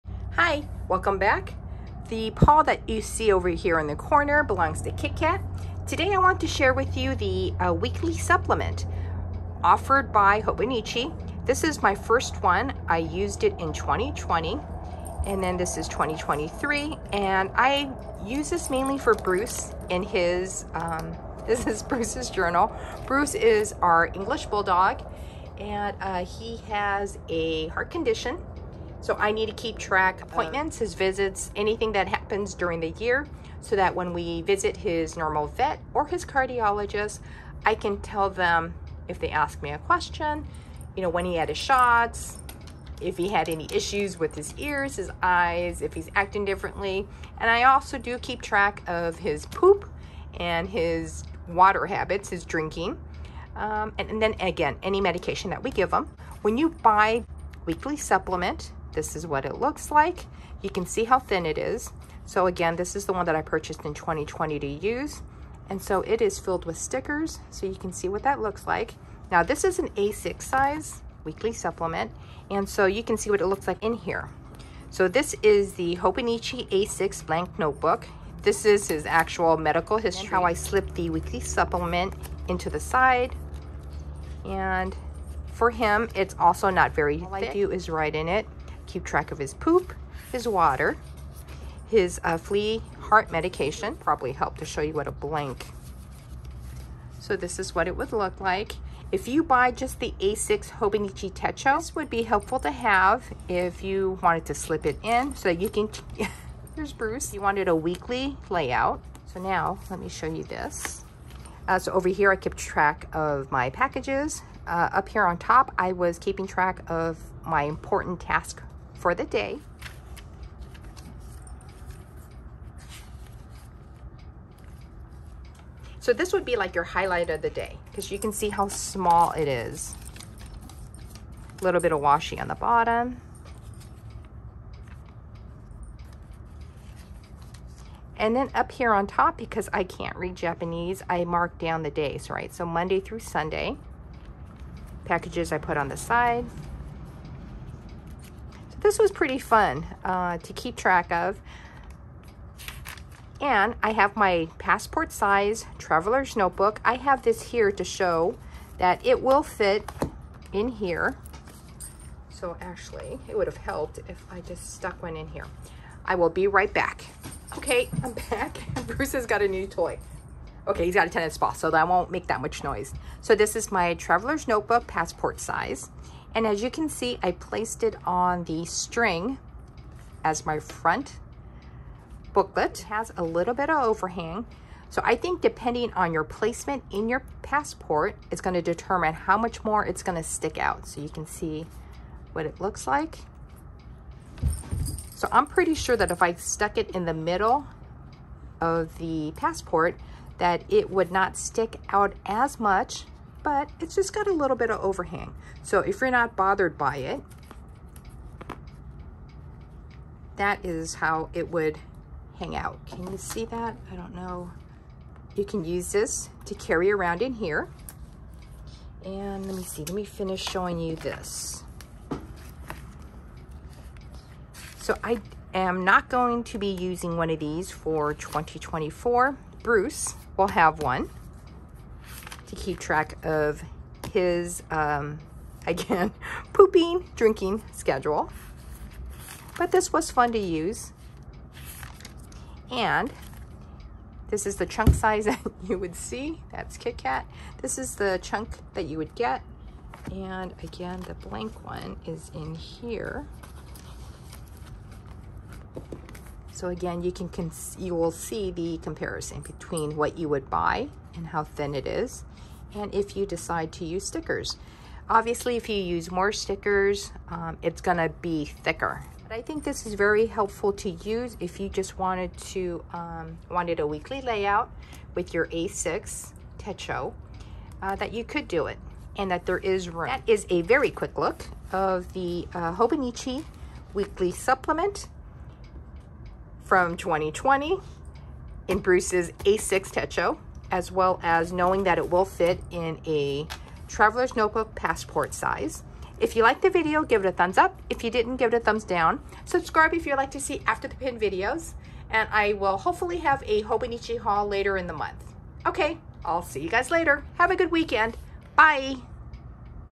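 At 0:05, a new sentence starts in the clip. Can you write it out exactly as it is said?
Today I want to share with you the uh, weekly supplement offered by Hobonichi.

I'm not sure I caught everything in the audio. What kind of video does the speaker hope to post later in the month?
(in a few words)
A Hobonichi haul.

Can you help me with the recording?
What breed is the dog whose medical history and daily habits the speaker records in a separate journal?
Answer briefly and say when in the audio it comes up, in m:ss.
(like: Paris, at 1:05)
English Bulldog, at 0:24.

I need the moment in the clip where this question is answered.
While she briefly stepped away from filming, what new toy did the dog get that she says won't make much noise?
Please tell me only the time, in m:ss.
2:51.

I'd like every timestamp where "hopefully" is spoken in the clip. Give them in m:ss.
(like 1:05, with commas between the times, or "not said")
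5:02.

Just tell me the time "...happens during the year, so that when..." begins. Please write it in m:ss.
0:32.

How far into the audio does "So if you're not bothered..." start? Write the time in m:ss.
3:25.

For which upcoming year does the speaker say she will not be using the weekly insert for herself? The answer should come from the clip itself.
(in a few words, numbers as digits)
2024.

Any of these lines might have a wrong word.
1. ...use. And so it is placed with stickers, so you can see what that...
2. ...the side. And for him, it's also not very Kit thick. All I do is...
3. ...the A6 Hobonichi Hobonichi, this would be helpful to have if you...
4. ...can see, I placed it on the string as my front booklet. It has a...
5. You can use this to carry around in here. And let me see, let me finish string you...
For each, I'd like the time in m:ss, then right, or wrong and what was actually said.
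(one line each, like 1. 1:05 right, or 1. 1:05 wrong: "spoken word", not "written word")
1. 1:04 wrong: "filled", not "placed"
2. 1:22 wrong: "All", not "Kit"
3. 1:39 wrong: "Techo", not "Hobonichi"
4. 2:56 right
5. 3:35 wrong: "showing", not "string".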